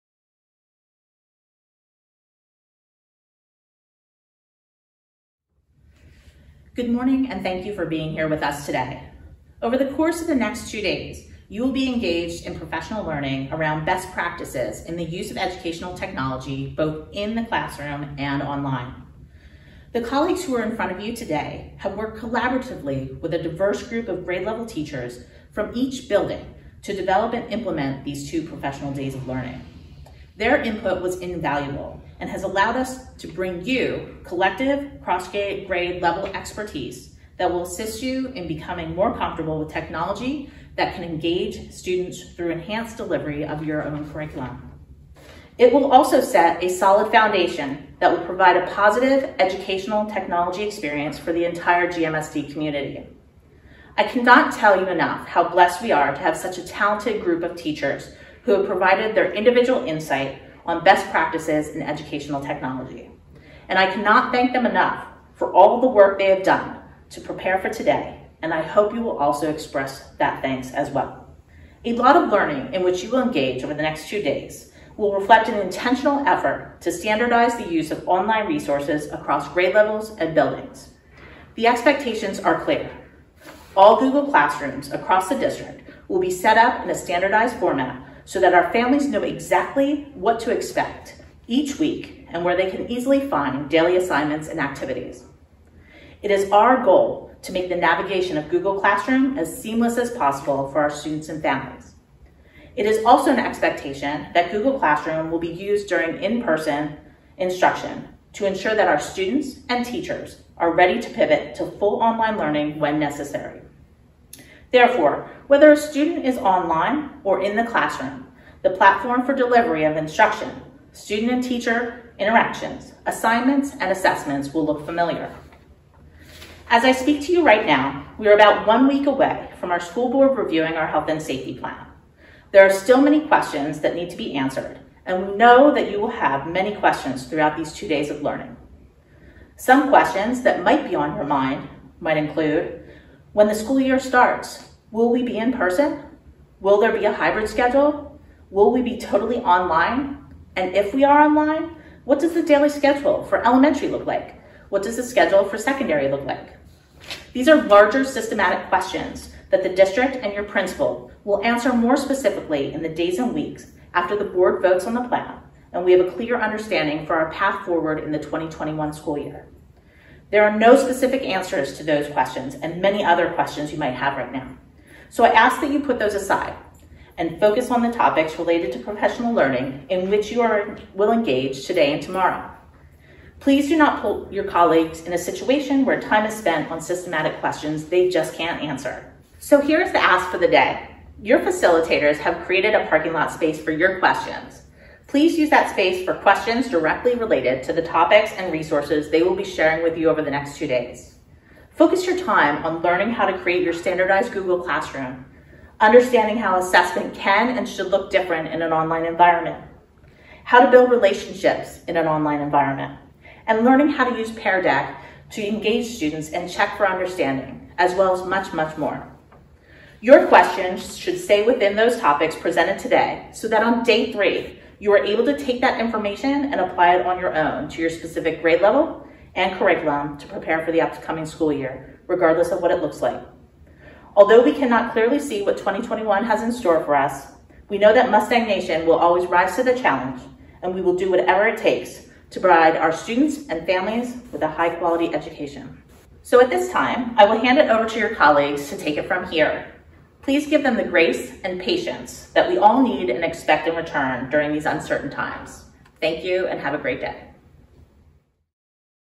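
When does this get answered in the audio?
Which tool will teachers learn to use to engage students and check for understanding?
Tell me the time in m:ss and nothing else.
3:34.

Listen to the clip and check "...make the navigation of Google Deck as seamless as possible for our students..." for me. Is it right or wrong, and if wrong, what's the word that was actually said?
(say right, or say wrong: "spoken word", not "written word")
wrong: "Classroom", not "Deck".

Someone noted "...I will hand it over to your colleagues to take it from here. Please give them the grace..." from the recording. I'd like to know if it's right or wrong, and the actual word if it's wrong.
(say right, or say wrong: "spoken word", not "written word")
right.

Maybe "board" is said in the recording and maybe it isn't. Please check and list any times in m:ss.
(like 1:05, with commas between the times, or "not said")
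2:10, 2:44.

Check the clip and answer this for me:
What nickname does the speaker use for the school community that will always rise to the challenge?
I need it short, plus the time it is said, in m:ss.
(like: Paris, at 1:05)
Mustang Nation, at 3:58.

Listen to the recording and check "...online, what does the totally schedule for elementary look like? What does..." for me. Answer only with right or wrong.
wrong.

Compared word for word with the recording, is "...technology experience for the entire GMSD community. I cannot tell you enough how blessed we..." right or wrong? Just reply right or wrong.
right.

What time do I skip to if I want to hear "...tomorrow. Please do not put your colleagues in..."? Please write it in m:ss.
3:02.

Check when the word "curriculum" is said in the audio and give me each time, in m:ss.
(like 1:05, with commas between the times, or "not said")
0:44, 3:49.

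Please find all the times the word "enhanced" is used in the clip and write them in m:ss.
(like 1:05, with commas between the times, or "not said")
0:42.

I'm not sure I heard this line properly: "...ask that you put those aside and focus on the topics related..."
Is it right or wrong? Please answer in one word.
right.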